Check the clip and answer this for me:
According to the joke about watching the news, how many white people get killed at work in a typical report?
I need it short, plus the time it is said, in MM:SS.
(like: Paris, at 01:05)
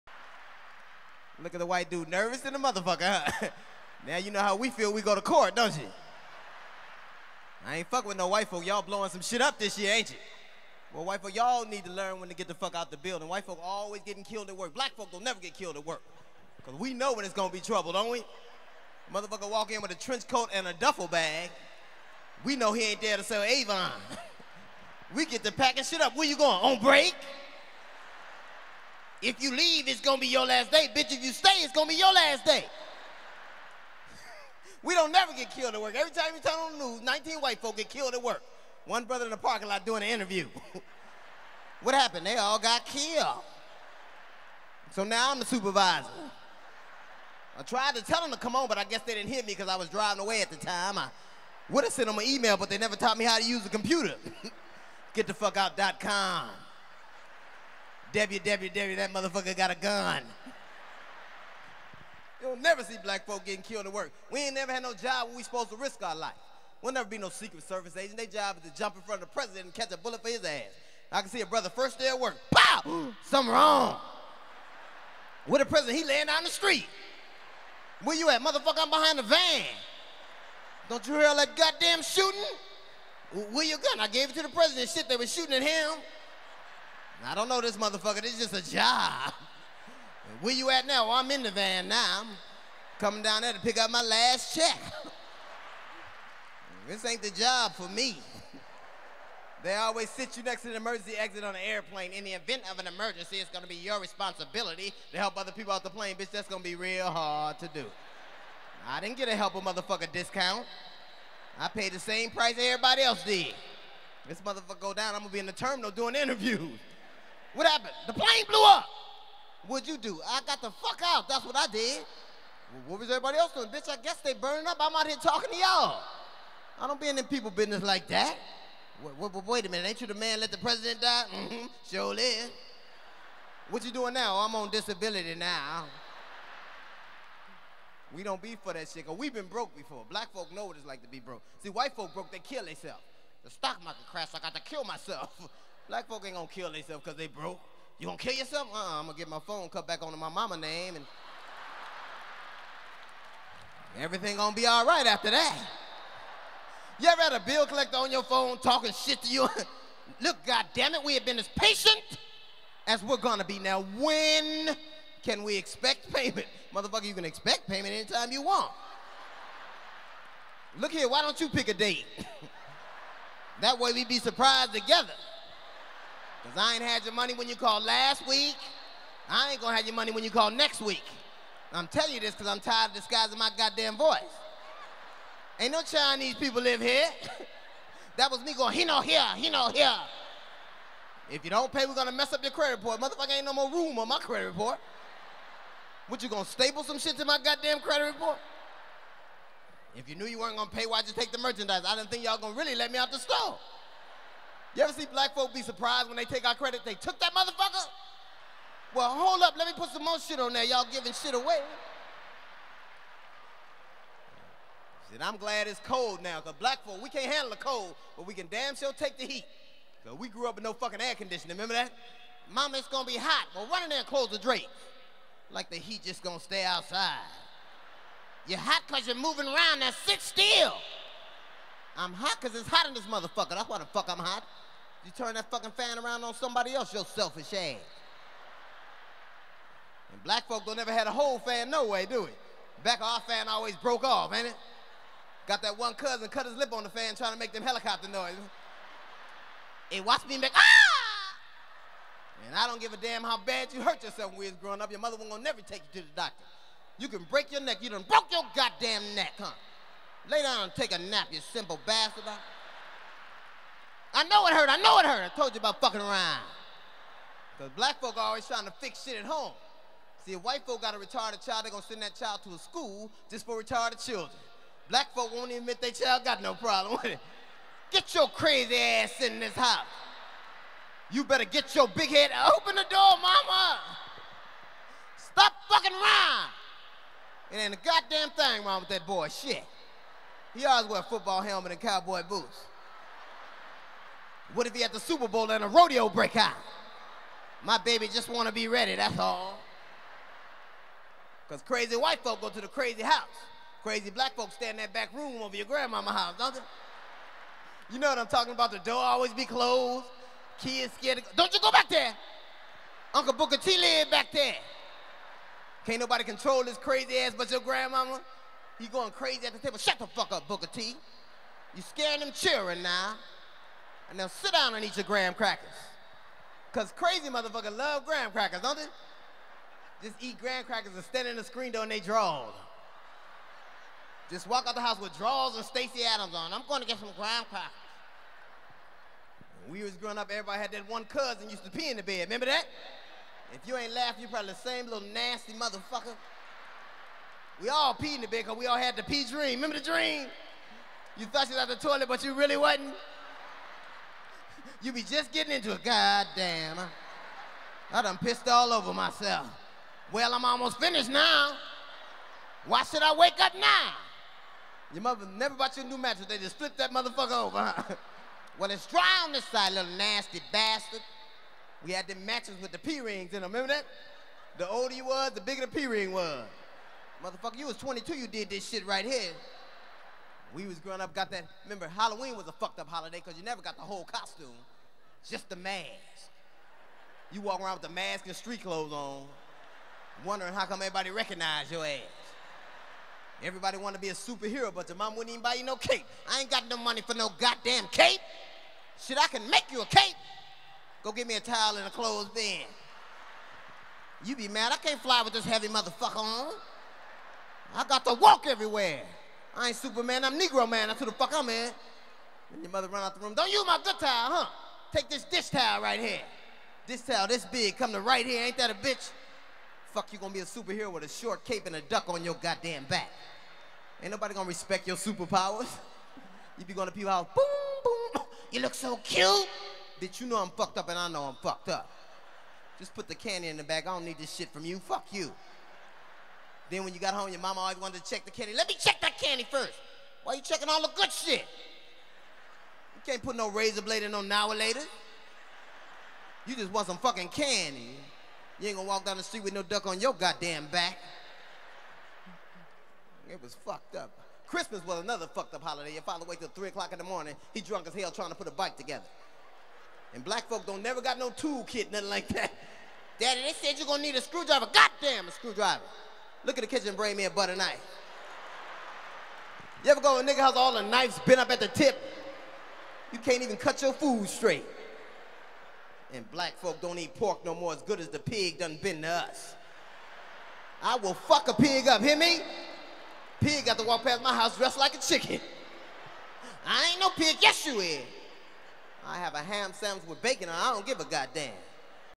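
19, at 00:37.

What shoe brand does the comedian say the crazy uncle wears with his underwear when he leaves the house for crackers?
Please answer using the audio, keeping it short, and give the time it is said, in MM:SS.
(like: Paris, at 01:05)
Stacy Adams, at 05:35.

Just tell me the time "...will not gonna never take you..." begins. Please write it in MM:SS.
04:15.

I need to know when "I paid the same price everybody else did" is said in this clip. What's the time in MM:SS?
01:51.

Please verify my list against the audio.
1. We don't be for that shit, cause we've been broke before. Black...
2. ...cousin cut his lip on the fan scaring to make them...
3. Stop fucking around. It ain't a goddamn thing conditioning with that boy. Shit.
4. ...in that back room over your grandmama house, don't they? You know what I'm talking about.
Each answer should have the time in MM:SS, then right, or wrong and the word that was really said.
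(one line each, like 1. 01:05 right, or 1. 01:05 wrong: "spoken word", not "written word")
1. 02:18 right
2. 04:05 wrong: "trying", not "scaring"
3. 04:45 wrong: "wrong", not "conditioning"
4. 05:04 right.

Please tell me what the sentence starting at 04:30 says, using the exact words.
See, if white folk got a retarded child, they're going to send that child to a school just for retarded children.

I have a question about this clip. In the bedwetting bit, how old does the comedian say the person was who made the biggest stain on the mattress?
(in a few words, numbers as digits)
22.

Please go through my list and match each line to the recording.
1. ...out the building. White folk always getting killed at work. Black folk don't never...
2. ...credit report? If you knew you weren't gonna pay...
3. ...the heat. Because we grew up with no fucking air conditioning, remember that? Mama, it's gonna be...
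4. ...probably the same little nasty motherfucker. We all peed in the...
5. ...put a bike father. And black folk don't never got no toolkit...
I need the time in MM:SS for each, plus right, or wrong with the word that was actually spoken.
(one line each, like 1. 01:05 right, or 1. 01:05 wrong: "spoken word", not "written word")
1. 00:12 right
2. 03:17 right
3. 03:39 right
4. 05:44 right
5. 07:38 wrong: "together", not "father".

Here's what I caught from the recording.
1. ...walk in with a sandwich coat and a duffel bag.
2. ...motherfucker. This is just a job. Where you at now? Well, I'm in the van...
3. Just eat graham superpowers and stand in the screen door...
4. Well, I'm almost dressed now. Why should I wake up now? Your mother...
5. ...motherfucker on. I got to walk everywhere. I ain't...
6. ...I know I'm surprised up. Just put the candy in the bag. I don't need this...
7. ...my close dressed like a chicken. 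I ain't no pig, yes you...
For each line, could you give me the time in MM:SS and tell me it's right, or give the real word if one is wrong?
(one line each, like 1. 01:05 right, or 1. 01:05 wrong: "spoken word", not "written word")
1. 00:19 wrong: "trench", not "sandwich"
2. 01:27 right
3. 05:30 wrong: "crackers", not "superpowers"
4. 06:00 wrong: "finished", not "dressed"
5. 06:45 right
6. 07:10 wrong: "fucked", not "surprised"
7. 08:04 wrong: "house", not "close".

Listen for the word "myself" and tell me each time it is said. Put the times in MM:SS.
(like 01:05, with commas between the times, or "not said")
02:24, 05:58.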